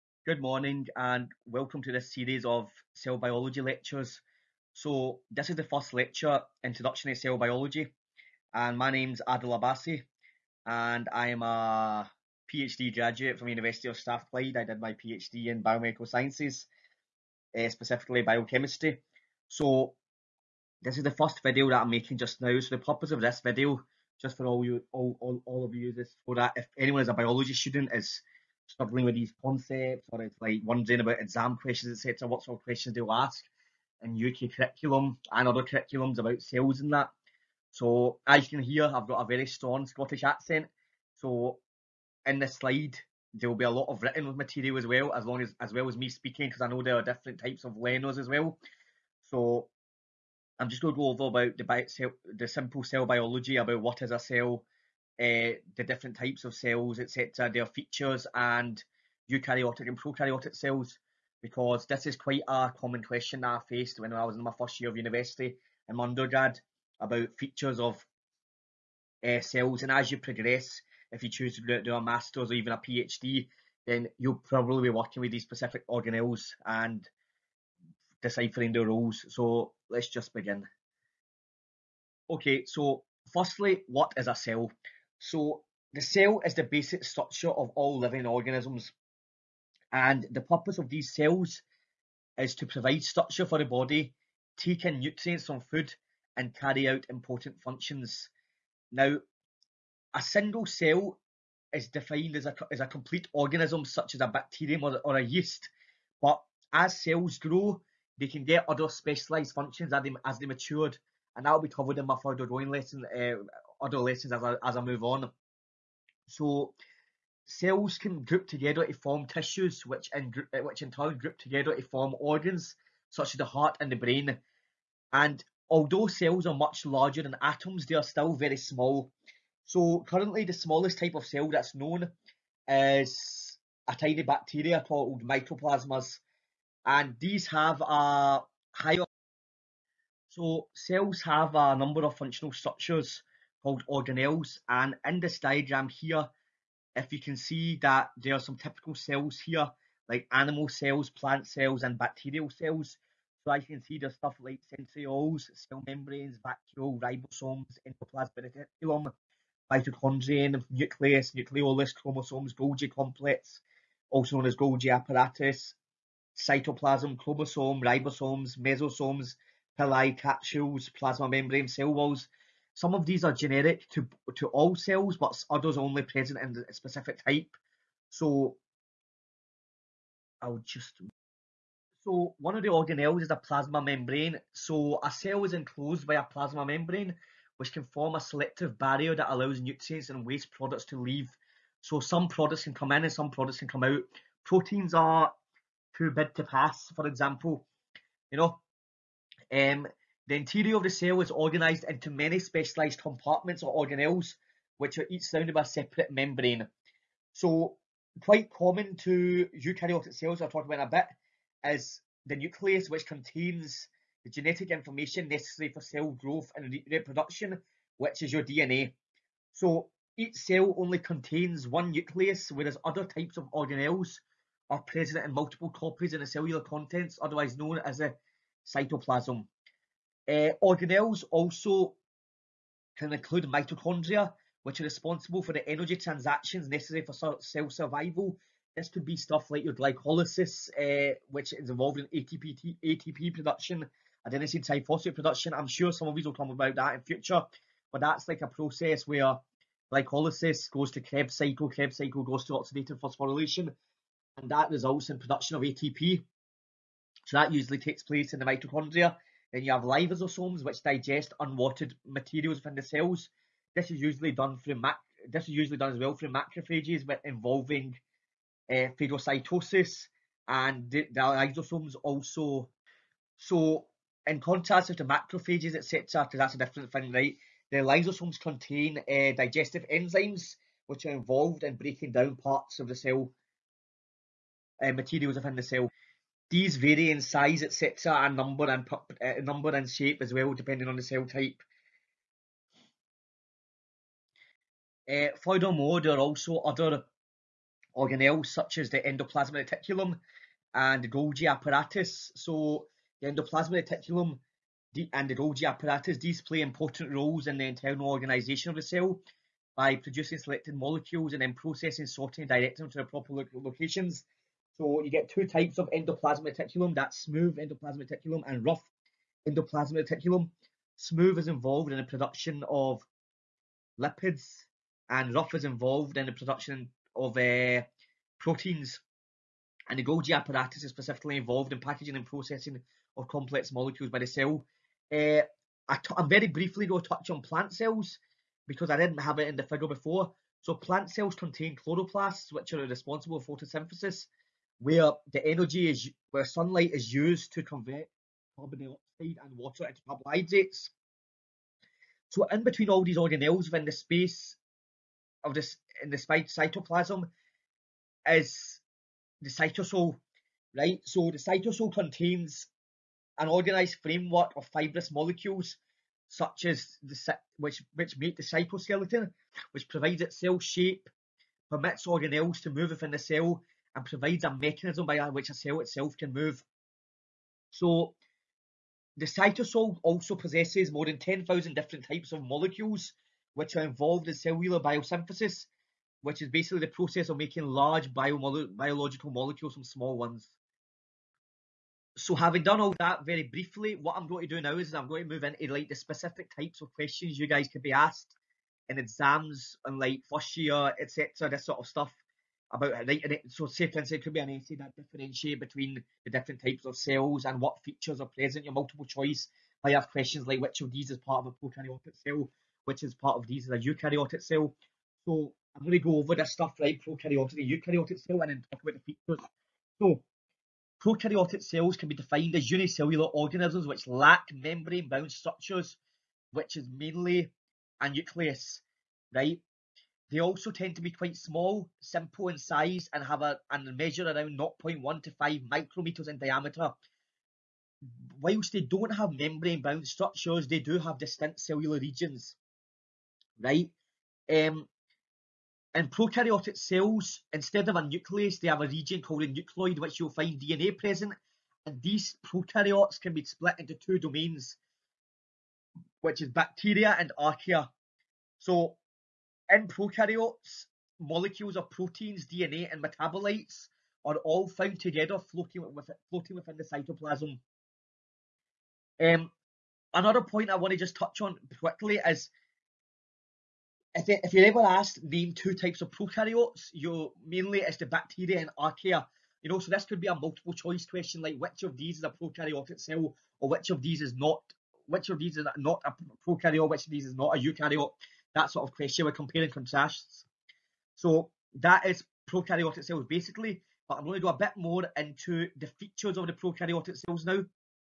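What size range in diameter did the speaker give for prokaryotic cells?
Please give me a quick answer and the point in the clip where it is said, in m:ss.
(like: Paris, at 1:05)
0.1 to 5 micrometers, at 7:14.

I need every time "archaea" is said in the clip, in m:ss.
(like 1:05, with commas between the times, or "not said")
7:37, 7:58.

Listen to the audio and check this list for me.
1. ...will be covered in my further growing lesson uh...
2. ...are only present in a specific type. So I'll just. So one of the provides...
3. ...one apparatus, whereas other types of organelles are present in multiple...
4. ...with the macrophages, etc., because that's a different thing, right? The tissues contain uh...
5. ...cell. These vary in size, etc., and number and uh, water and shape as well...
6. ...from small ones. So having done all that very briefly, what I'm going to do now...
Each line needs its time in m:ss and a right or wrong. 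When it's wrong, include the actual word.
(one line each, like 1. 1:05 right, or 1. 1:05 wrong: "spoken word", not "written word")
1. 1:51 right
2. 2:55 wrong: "organelles", not "provides"
3. 3:41 wrong: "nucleus", not "apparatus"
4. 4:34 wrong: "lysosomes", not "tissues"
5. 4:45 wrong: "number", not "water"
6. 6:29 right.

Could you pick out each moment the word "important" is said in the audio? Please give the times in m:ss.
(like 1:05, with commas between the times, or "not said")
1:37, 5:06.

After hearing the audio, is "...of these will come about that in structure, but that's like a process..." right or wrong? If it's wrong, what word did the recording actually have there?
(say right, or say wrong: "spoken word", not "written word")
wrong: "future", not "structure".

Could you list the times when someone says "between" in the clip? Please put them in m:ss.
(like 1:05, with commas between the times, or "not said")
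5:52, 6:45.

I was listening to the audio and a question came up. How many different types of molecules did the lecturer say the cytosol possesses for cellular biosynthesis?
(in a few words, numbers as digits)
More than 10,000.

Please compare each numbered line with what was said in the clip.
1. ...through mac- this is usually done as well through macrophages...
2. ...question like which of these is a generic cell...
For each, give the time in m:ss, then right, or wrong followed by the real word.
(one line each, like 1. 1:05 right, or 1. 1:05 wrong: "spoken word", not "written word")
1. 4:24 right
2. 8:01 wrong: "prokaryotic", not "generic".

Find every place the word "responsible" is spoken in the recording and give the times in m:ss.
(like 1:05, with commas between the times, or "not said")
3:54, 5:42.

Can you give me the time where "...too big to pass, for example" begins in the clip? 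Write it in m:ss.
3:15.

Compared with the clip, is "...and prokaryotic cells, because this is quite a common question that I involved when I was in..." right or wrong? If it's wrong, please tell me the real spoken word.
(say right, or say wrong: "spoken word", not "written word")
wrong: "faced", not "involved".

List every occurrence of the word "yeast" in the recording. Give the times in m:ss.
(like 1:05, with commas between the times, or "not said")
1:45.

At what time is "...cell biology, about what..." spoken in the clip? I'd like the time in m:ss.
0:52.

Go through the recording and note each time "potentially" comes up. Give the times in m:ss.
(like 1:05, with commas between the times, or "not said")
not said.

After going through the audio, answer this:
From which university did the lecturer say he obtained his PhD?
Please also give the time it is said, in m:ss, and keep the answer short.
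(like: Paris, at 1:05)
University of Strathclyde, at 0:13.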